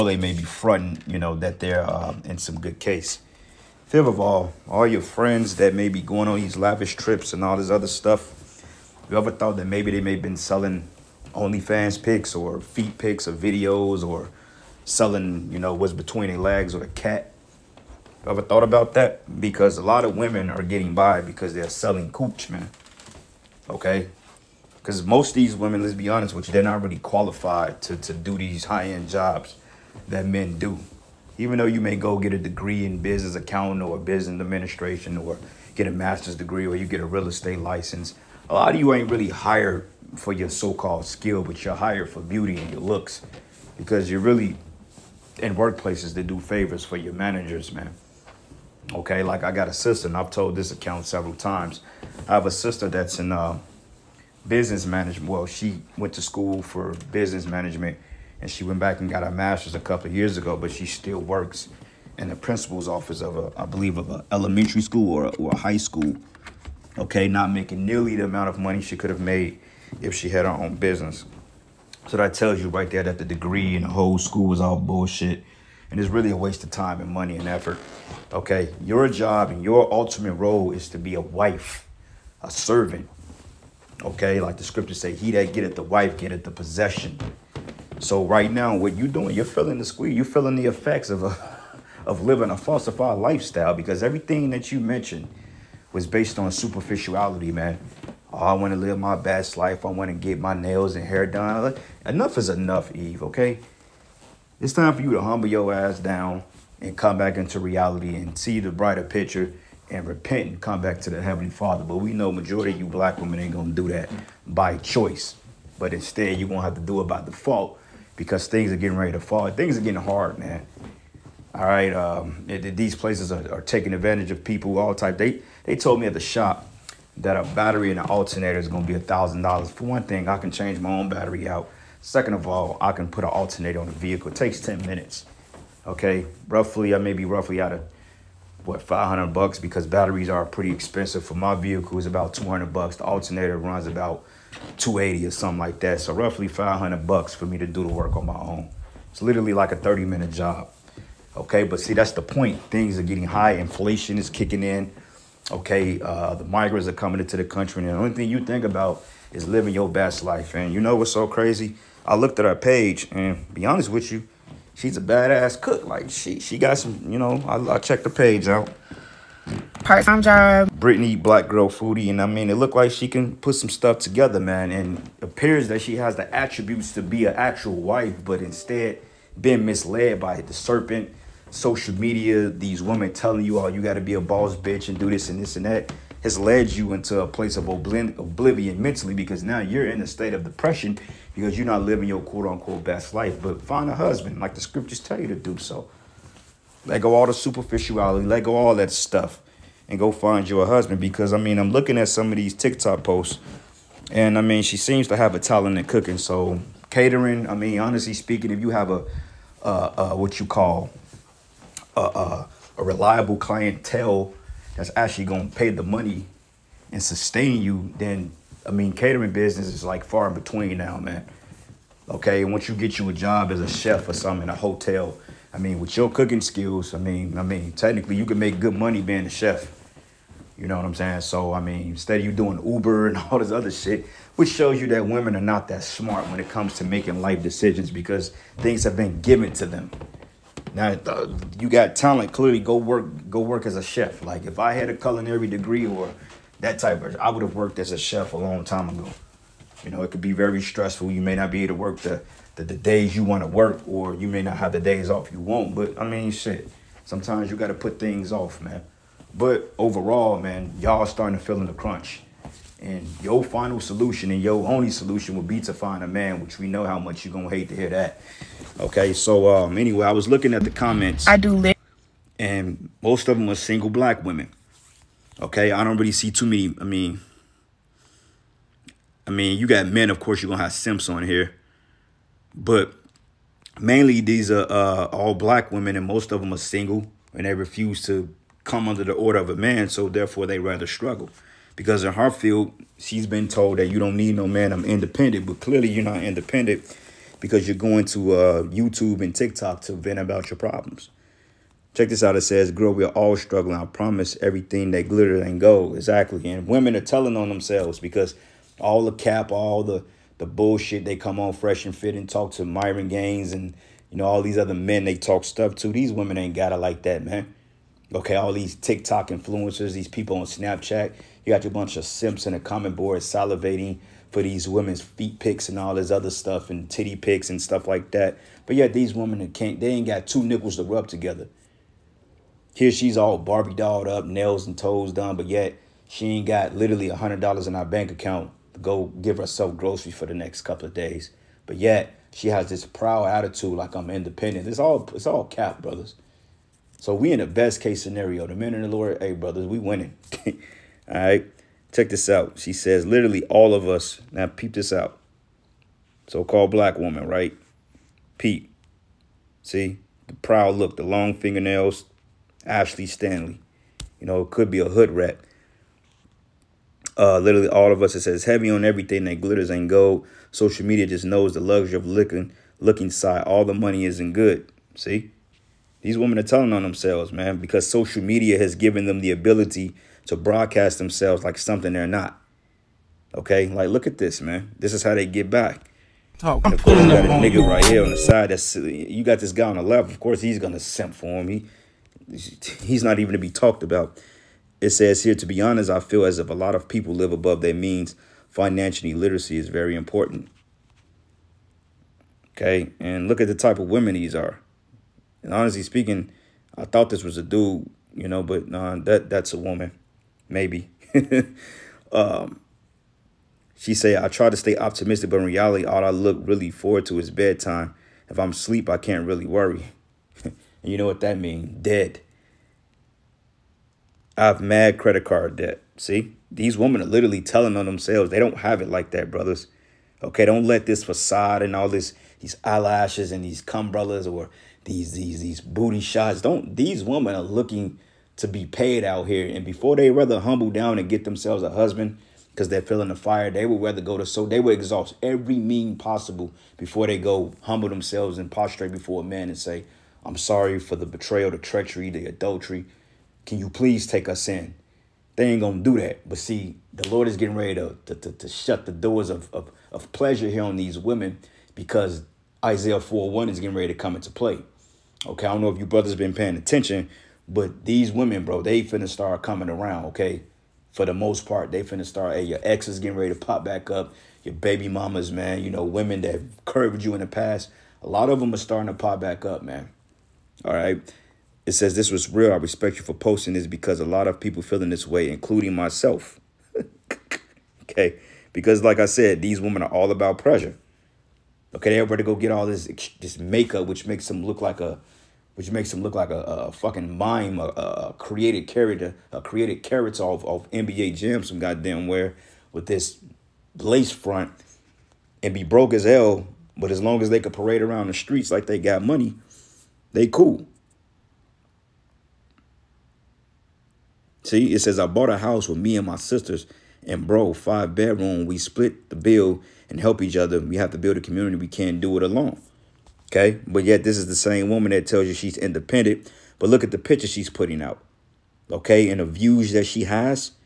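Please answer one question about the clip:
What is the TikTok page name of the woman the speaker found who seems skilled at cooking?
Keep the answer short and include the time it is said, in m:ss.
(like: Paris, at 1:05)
Brittany Black Girl Foodie, at 2:50.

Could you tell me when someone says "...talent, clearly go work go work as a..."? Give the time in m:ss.
4:01.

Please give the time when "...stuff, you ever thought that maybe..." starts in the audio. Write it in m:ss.
0:07.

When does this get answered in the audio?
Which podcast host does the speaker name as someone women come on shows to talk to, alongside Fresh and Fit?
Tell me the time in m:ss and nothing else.
5:12.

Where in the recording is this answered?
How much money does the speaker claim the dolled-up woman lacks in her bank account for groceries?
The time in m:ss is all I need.
5:37.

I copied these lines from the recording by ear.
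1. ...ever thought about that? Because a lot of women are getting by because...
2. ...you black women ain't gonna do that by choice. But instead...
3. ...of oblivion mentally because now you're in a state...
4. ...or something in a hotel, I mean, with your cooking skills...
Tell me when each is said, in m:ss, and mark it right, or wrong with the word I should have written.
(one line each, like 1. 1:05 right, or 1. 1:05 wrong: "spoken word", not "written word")
1. 0:18 right
2. 1:52 right
3. 3:07 right
4. 3:44 right.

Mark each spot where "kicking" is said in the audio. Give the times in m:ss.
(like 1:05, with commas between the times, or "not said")
2:34.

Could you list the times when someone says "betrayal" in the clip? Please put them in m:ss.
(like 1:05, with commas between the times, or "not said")
7:31.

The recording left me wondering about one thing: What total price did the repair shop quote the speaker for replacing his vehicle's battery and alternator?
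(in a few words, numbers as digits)
$1,000.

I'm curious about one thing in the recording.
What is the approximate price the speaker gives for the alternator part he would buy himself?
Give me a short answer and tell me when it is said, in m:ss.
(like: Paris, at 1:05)
280, at 2:24.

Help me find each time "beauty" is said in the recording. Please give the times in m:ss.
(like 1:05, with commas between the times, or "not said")
0:42.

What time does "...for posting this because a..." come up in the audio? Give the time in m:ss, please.
8:03.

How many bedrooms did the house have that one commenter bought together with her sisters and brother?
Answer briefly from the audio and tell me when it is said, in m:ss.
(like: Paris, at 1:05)
5, at 8:37.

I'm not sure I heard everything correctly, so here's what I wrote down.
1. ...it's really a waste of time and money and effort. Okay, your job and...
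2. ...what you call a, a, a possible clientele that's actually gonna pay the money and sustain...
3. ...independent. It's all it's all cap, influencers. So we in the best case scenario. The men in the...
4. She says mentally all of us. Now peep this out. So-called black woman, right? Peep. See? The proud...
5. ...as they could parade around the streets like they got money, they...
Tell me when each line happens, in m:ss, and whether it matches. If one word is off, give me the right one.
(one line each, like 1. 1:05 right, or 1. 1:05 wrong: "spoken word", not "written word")
1. 1:15 right
2. 3:30 wrong: "reliable", not "possible"
3. 5:44 wrong: "brothers", not "influencers"
4. 5:52 wrong: "literally", not "mentally"
5. 8:27 right.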